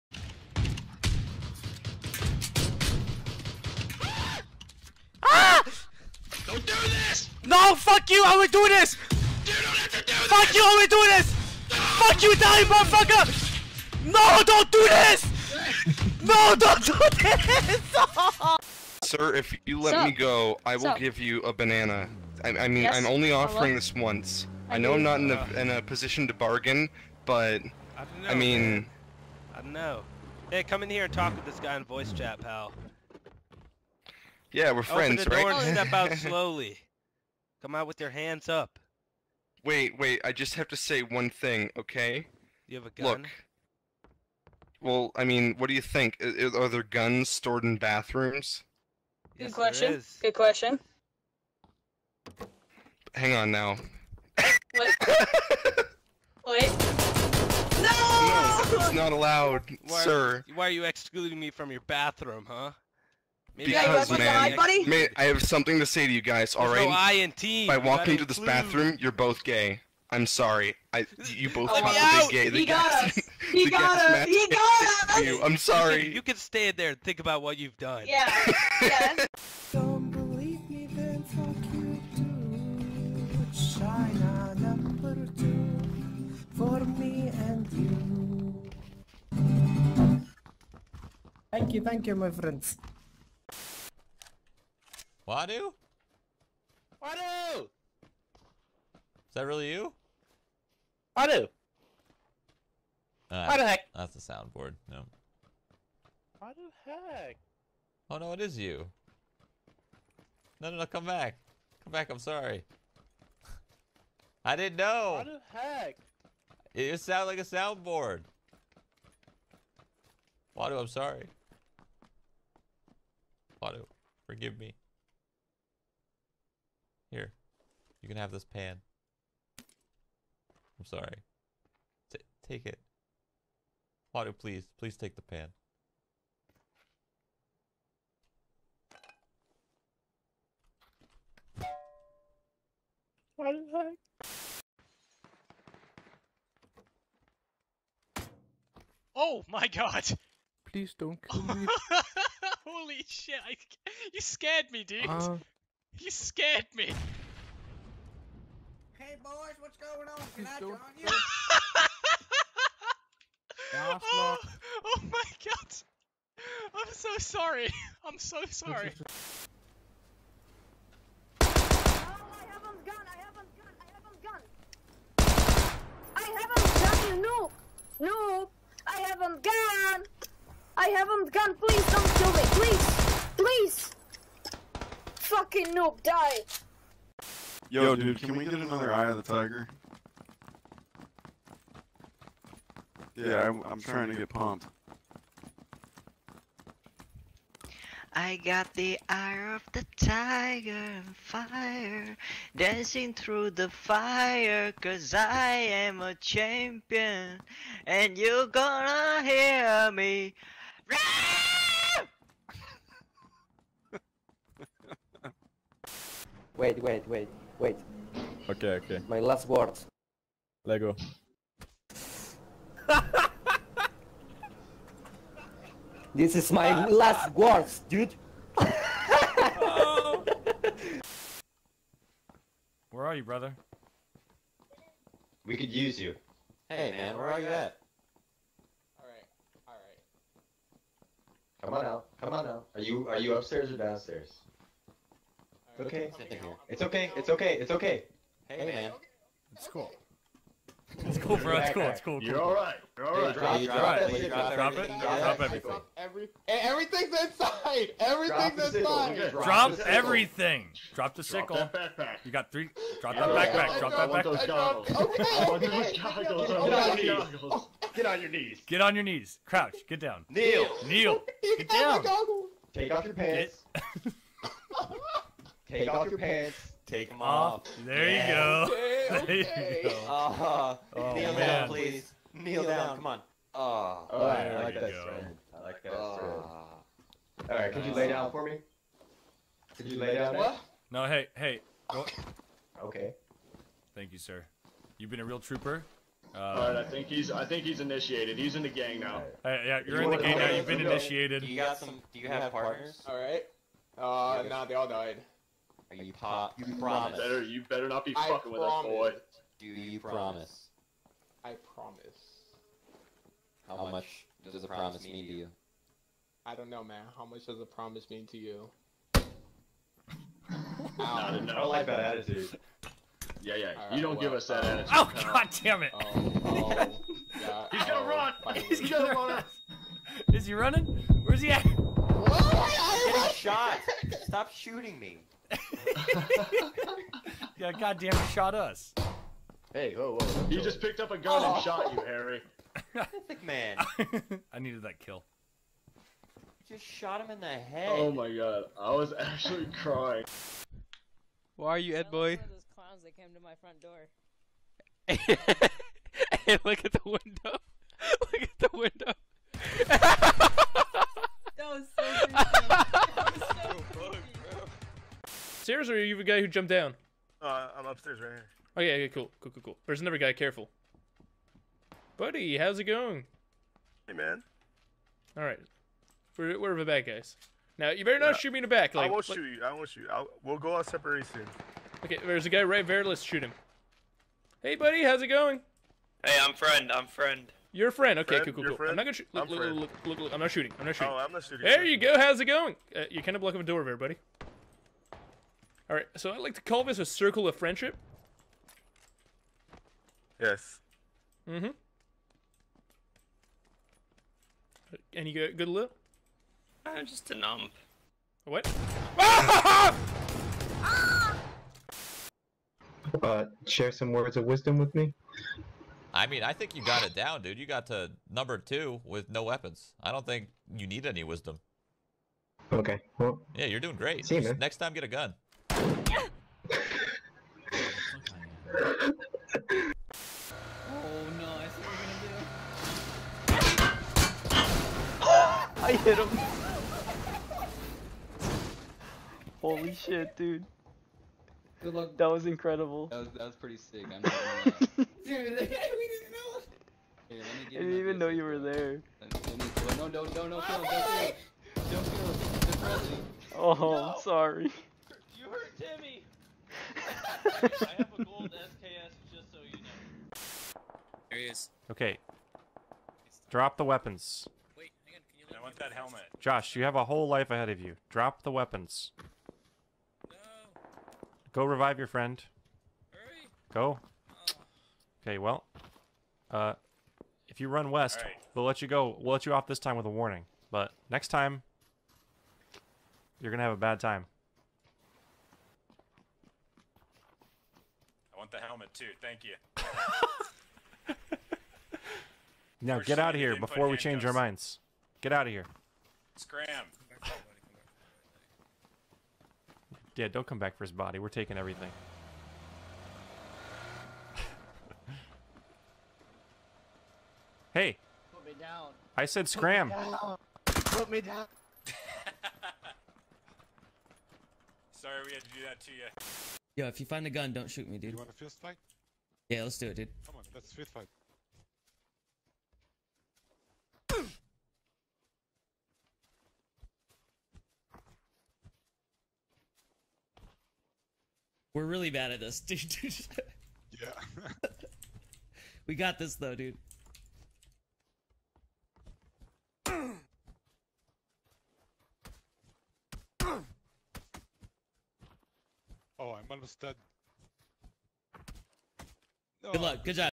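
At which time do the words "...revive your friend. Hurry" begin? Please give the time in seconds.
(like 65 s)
471 s.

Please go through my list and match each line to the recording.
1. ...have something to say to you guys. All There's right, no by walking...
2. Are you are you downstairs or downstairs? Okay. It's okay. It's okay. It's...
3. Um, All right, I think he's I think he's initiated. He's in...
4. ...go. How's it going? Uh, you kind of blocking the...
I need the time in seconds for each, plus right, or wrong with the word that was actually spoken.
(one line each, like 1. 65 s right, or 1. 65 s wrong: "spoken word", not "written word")
1. 65 s right
2. 242 s wrong: "upstairs", not "downstairs"
3. 296 s right
4. 391 s right.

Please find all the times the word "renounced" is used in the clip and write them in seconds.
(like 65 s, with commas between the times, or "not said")
not said.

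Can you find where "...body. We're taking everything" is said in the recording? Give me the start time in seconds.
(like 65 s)
500 s.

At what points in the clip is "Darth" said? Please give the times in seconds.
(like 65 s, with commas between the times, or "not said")
not said.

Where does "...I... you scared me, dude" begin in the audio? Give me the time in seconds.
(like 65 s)
153 s.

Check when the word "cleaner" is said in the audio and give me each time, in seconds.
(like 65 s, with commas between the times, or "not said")
not said.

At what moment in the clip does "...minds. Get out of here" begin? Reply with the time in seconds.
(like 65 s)
494 s.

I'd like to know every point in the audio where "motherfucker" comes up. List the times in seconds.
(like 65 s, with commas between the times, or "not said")
12 s.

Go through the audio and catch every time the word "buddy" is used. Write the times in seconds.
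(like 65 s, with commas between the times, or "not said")
372 s, 384 s, 393 s.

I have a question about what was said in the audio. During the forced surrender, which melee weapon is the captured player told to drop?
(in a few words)
sickle.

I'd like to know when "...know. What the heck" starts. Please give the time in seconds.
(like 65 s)
114 s.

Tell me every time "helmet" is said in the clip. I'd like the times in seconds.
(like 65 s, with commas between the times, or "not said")
465 s, 488 s.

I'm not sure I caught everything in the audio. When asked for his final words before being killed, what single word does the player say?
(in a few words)
Lego.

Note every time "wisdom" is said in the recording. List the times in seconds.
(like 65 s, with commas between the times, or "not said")
414 s, 421 s.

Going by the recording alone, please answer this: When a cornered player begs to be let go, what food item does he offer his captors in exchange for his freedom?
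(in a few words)
banana.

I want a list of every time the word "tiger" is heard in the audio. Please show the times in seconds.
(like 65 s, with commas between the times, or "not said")
189 s, 199 s.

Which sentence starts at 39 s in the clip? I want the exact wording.
Wait, wait, I just have to say one thing, okay?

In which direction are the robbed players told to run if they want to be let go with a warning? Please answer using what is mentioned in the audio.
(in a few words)
west.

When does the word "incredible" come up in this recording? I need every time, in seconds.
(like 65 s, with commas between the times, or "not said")
442 s.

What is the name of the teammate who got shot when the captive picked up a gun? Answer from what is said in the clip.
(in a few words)
Harry.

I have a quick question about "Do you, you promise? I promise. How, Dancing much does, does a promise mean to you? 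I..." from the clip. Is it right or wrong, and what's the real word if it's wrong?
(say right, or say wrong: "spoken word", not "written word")
wrong: "How", not "Dancing".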